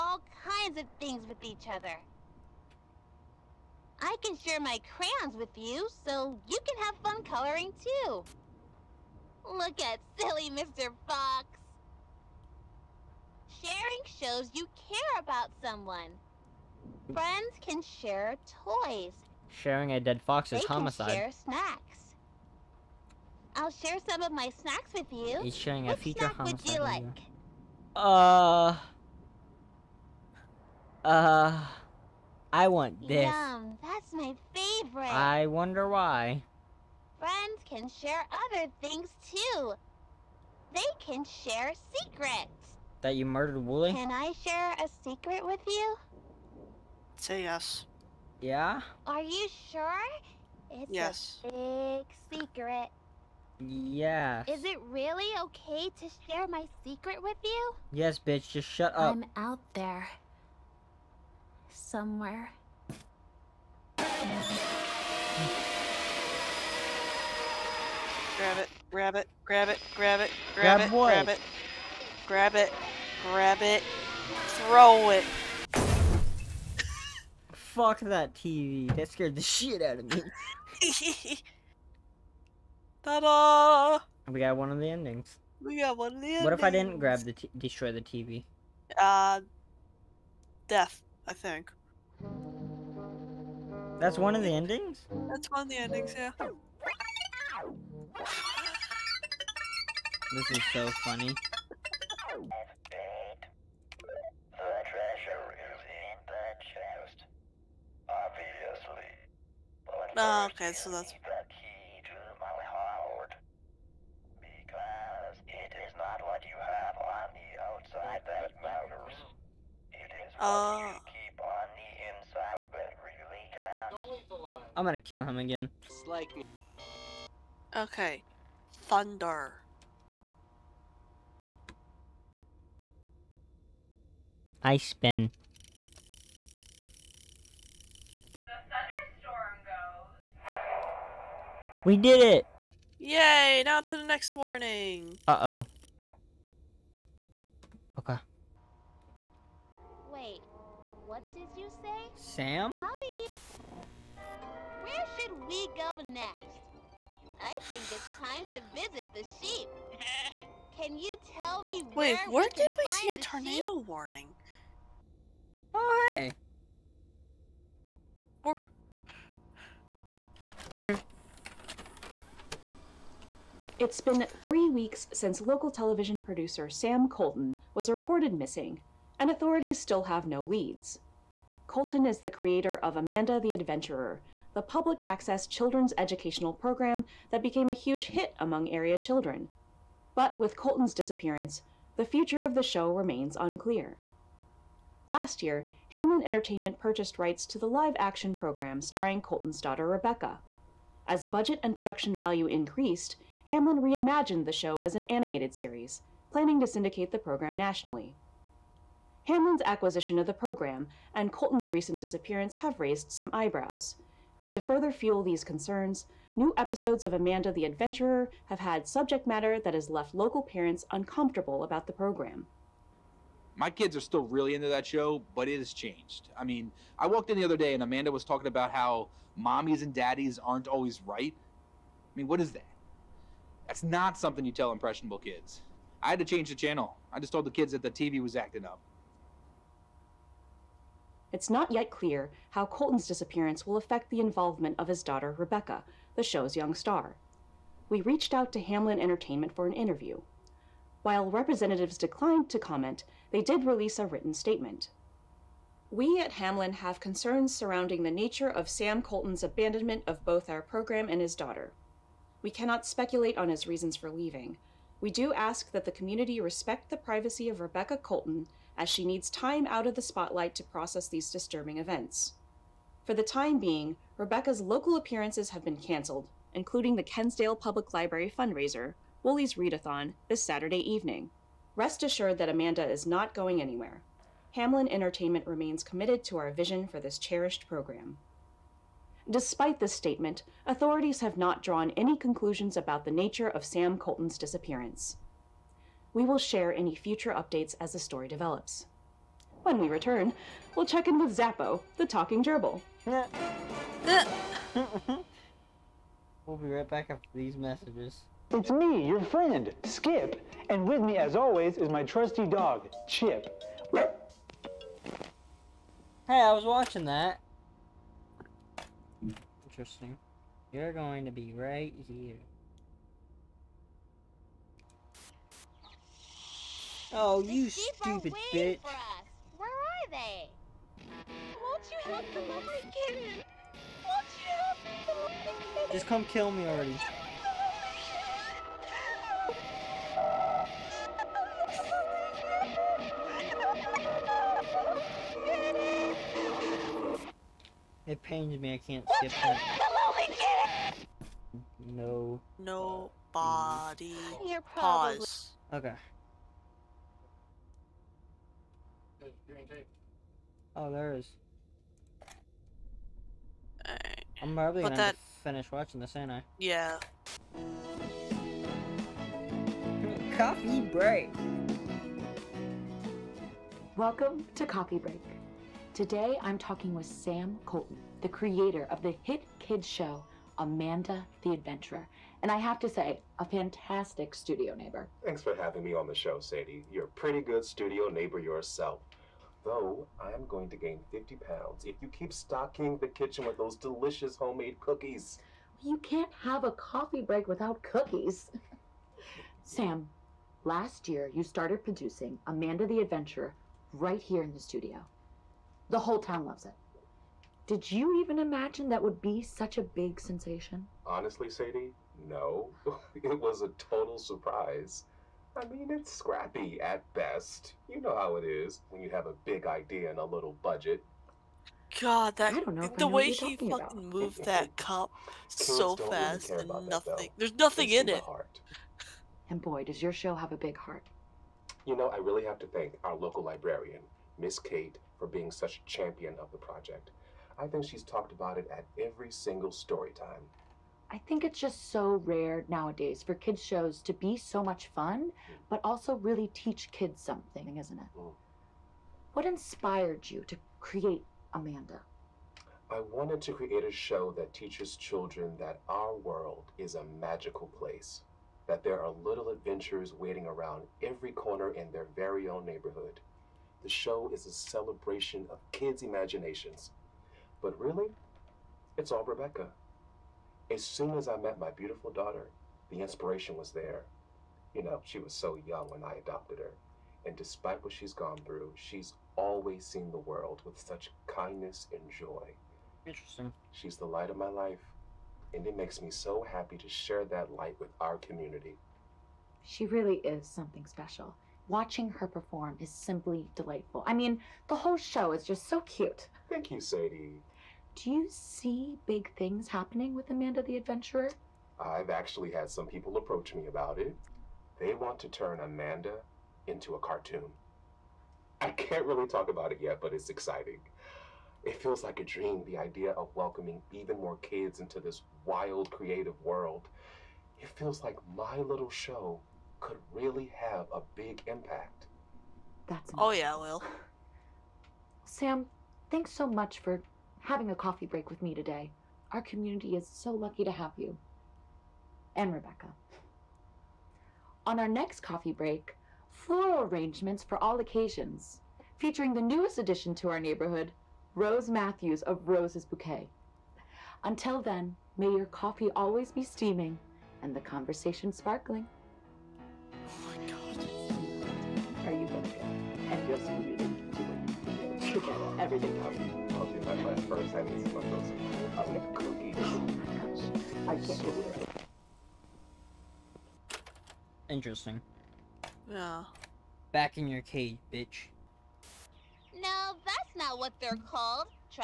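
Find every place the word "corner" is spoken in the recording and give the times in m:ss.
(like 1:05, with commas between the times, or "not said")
7:41.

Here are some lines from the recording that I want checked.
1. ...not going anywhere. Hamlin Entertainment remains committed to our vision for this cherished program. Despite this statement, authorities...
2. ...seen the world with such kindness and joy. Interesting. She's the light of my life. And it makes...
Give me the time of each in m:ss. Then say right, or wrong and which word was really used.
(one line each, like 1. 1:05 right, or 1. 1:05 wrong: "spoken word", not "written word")
1. 4:43 right
2. 7:59 right.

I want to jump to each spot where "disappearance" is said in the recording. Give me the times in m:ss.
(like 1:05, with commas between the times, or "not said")
3:10, 3:31, 4:03, 4:54.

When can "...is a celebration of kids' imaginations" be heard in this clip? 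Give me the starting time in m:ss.
7:44.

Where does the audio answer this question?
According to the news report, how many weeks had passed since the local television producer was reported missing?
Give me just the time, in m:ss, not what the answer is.
2:54.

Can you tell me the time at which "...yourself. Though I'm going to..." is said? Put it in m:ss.
6:28.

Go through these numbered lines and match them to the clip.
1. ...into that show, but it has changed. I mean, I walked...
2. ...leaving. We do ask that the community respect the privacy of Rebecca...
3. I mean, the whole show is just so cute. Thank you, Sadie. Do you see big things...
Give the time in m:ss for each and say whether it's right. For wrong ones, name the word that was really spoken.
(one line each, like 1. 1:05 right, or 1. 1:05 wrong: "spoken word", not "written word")
1. 3:44 right
2. 4:24 right
3. 8:14 right.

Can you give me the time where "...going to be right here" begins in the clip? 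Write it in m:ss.
5:20.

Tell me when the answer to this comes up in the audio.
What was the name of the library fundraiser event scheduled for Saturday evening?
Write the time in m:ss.
4:39.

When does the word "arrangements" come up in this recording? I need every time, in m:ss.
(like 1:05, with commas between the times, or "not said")
8:56.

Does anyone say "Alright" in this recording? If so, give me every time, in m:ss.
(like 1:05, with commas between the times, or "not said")
6:03.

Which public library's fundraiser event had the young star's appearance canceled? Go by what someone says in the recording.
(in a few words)
Kensdale Public Library.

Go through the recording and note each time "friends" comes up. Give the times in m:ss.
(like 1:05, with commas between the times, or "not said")
0:17, 0:37, 5:09.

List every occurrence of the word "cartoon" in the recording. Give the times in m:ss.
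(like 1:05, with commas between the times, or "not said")
8:26.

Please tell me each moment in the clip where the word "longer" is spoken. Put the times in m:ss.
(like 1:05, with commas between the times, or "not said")
not said.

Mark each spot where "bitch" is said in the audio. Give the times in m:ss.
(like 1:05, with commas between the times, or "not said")
0:58, 5:28, 9:27.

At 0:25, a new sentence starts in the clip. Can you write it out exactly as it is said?
He's sharing what a feature snack homicide.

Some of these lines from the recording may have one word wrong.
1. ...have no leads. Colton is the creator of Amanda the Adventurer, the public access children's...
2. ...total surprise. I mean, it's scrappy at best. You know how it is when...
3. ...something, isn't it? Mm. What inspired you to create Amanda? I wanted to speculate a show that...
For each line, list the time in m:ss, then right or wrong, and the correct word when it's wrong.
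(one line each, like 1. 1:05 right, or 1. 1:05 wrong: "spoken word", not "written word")
1. 3:00 right
2. 6:53 right
3. 7:27 wrong: "create", not "speculate".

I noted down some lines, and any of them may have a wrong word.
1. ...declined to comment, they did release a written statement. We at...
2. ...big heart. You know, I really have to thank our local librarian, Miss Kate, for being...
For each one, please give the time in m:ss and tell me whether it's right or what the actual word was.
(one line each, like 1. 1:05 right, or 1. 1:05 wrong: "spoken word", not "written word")
1. 4:11 right
2. 7:10 right.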